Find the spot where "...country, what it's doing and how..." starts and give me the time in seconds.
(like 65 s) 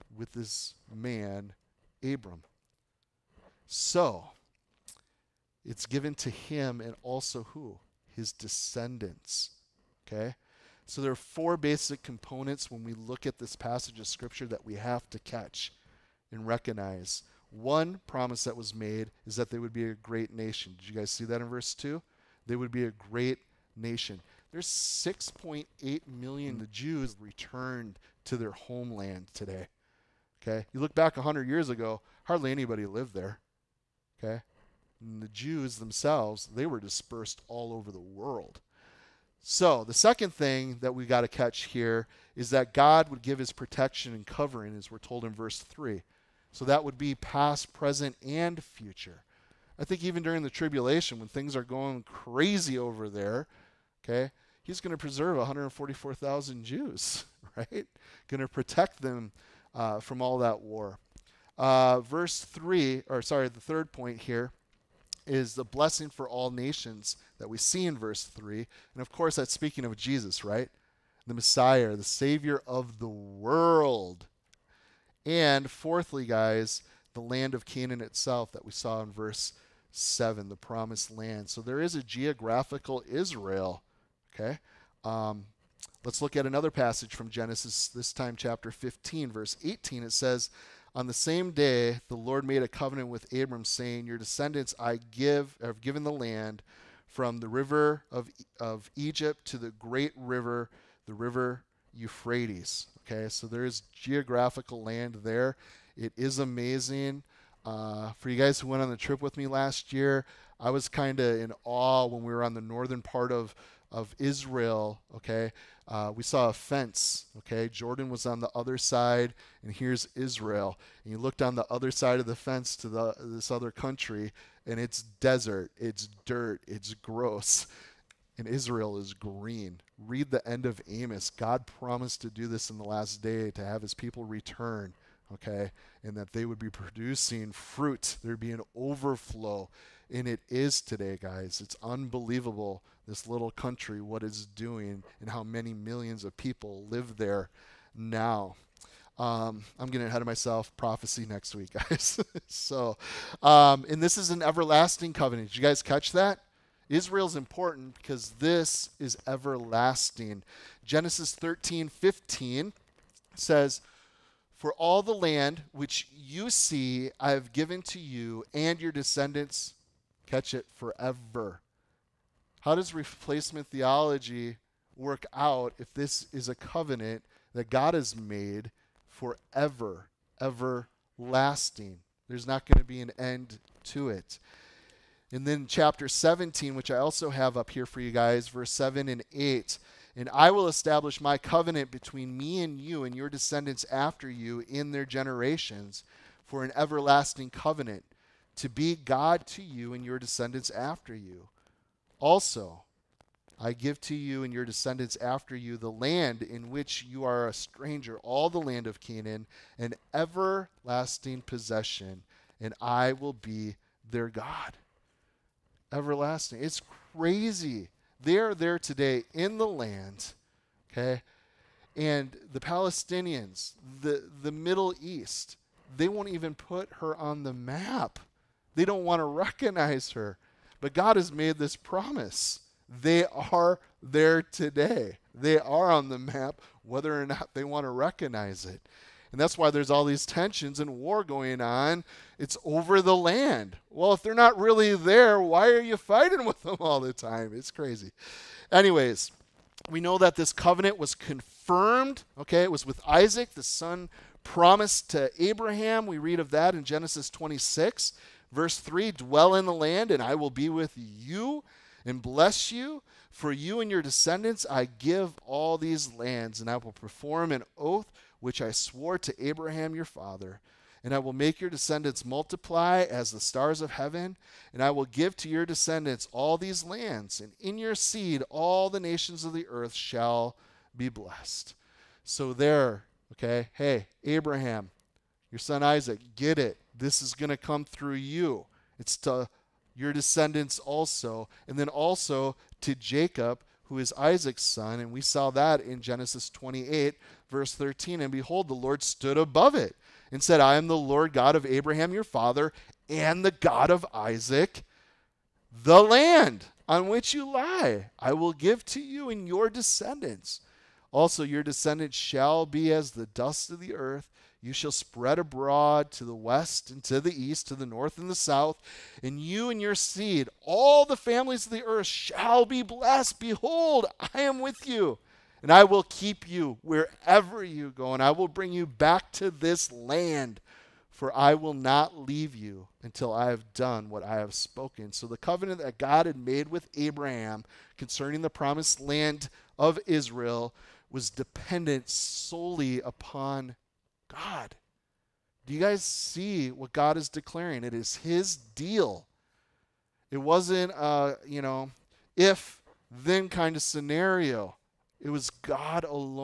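143 s.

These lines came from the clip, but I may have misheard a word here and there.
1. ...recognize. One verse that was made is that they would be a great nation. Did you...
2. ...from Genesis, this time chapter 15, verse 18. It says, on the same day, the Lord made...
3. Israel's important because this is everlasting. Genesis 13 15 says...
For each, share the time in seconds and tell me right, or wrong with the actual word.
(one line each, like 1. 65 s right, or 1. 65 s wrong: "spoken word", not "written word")
1. 16 s wrong: "promise", not "verse"
2. 87 s right
3. 156 s right.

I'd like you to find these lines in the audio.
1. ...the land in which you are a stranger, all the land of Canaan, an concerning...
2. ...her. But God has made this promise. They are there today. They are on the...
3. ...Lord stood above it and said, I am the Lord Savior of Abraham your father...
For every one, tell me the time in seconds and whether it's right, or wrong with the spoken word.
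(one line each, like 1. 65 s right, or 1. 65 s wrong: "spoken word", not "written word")
1. 205 s wrong: "everlasting", not "concerning"
2. 230 s right
3. 298 s wrong: "God", not "Savior".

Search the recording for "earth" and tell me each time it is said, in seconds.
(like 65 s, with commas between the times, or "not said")
279 s, 313 s, 321 s.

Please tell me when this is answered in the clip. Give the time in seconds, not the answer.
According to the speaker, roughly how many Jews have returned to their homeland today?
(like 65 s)
24 s.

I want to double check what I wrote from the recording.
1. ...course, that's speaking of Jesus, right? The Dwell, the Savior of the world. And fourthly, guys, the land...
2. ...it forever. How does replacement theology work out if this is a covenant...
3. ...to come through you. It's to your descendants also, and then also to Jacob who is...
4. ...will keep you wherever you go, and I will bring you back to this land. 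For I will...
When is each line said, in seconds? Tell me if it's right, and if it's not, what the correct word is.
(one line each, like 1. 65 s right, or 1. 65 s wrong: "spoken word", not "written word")
1. 69 s wrong: "Messiah", not "Dwell"
2. 170 s right
3. 287 s right
4. 325 s right.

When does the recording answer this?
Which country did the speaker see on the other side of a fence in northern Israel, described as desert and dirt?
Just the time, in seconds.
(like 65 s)
117 s.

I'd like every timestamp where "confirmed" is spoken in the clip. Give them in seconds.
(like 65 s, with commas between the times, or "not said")
251 s.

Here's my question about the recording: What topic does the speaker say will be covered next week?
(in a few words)
Prophecy.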